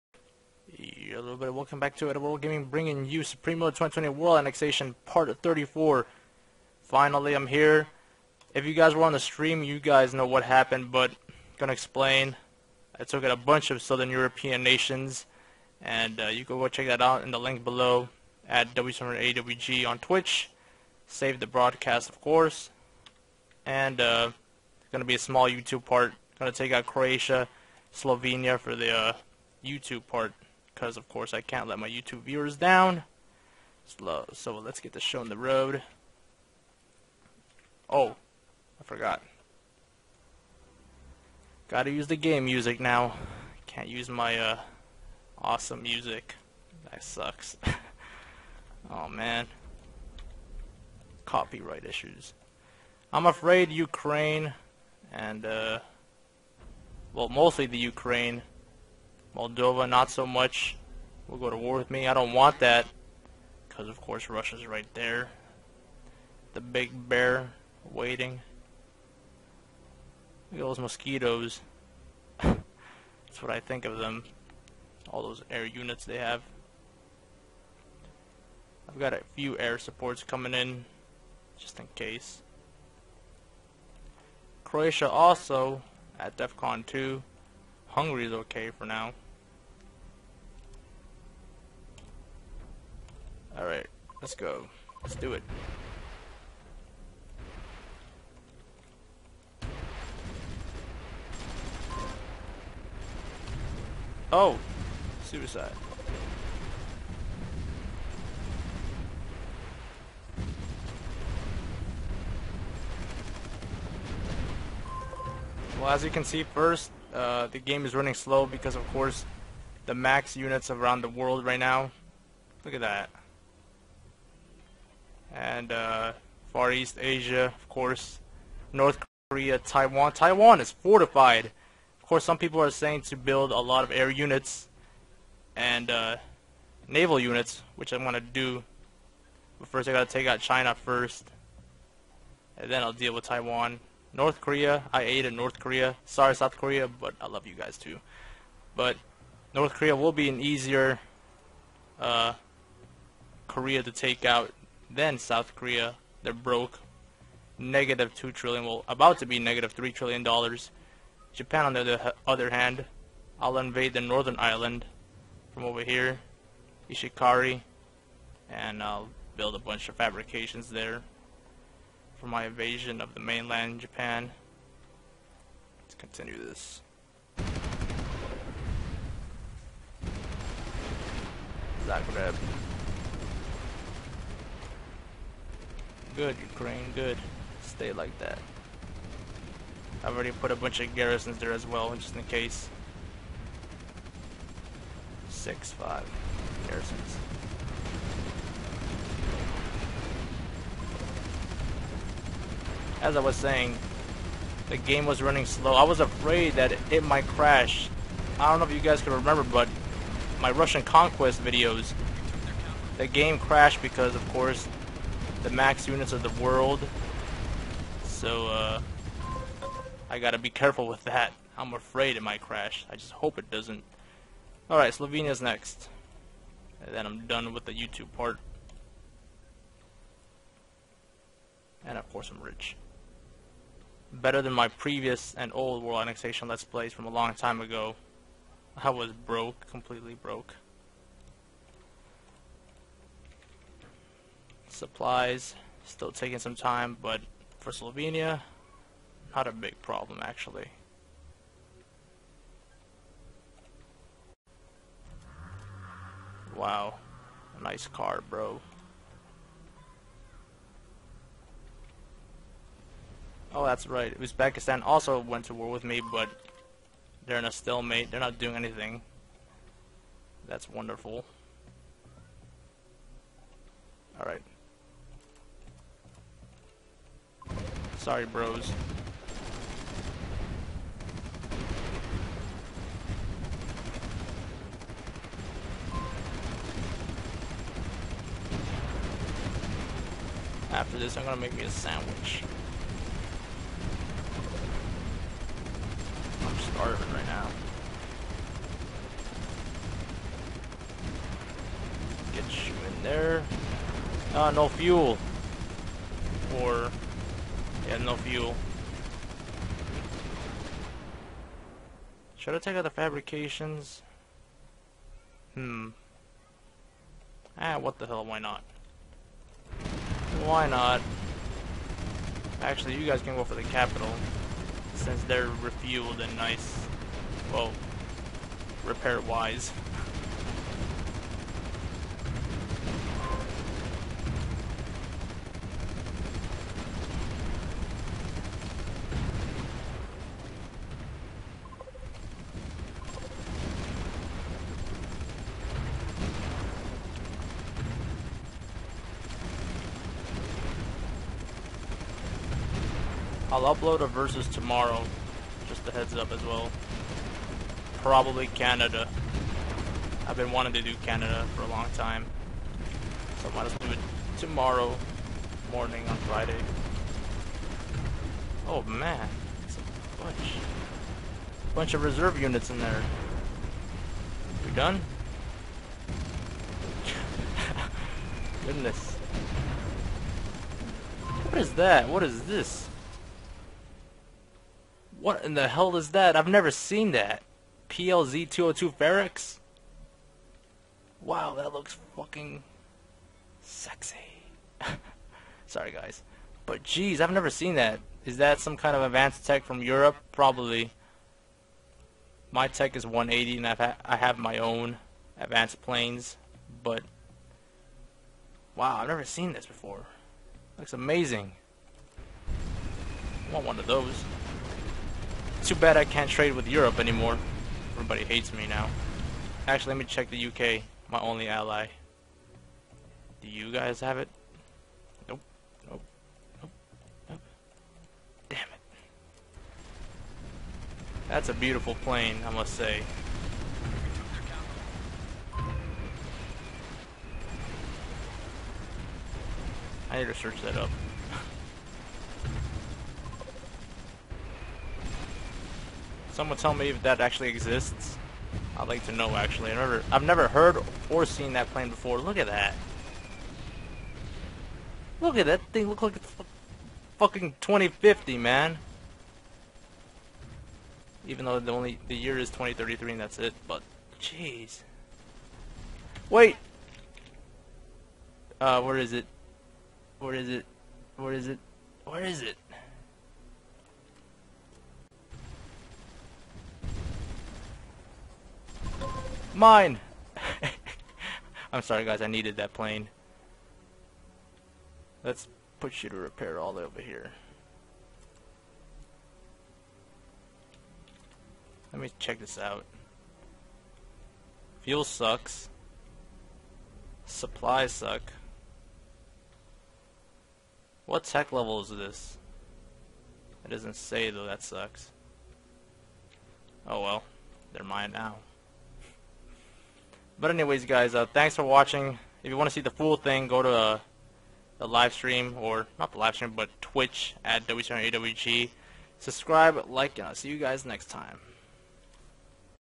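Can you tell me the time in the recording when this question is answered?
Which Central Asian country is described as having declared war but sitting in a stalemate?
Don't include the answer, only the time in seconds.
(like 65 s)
264 s.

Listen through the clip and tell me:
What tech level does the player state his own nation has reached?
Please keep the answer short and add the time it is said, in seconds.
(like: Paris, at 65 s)
180, at 403 s.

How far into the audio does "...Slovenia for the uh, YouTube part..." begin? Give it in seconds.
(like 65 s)
27 s.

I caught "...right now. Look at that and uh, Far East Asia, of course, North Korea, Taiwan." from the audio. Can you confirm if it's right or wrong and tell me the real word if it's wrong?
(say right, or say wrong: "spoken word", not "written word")
right.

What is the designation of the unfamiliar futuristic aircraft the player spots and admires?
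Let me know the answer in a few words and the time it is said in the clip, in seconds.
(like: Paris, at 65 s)
PLZ202 Ferex, at 387 s.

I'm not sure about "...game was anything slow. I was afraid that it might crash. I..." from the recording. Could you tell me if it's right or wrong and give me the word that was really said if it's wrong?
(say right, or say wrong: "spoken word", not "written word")
wrong: "running", not "anything".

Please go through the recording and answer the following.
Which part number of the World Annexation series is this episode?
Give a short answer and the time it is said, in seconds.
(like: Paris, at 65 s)
34, at 5 s.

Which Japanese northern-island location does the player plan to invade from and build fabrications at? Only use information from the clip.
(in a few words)
Ishikari.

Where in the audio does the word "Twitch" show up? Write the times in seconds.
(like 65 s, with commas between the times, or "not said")
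19 s, 516 s.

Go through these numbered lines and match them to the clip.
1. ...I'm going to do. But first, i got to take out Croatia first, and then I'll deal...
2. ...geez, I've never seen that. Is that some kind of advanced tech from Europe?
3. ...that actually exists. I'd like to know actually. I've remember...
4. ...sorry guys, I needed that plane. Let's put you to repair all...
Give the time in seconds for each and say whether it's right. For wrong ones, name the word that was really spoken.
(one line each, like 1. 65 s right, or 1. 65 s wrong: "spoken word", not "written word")
1. 137 s wrong: "China", not "Croatia"
2. 396 s right
3. 447 s wrong: "never", not "remember"
4. 481 s right.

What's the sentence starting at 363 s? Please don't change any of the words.
So I might as well do it tomorrow morning on Friday.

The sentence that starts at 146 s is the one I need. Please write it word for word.
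Sorry, South Korea, but I love you guys too.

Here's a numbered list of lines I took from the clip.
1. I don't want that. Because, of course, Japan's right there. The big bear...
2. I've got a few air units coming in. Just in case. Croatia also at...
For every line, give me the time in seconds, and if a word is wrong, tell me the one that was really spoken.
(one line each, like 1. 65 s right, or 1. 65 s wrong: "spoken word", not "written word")
1. 62 s wrong: "Russia", not "Japan"
2. 78 s wrong: "supports", not "units".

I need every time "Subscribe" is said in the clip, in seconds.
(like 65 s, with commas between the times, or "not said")
519 s.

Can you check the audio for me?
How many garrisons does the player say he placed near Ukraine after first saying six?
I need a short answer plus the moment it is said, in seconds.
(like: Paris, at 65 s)
5, at 195 s.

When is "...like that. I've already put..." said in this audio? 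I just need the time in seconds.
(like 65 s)
187 s.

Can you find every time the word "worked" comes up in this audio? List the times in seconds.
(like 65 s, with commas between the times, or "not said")
not said.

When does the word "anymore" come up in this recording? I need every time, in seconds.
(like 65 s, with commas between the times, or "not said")
416 s.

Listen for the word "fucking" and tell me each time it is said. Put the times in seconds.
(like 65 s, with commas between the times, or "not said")
392 s, 457 s.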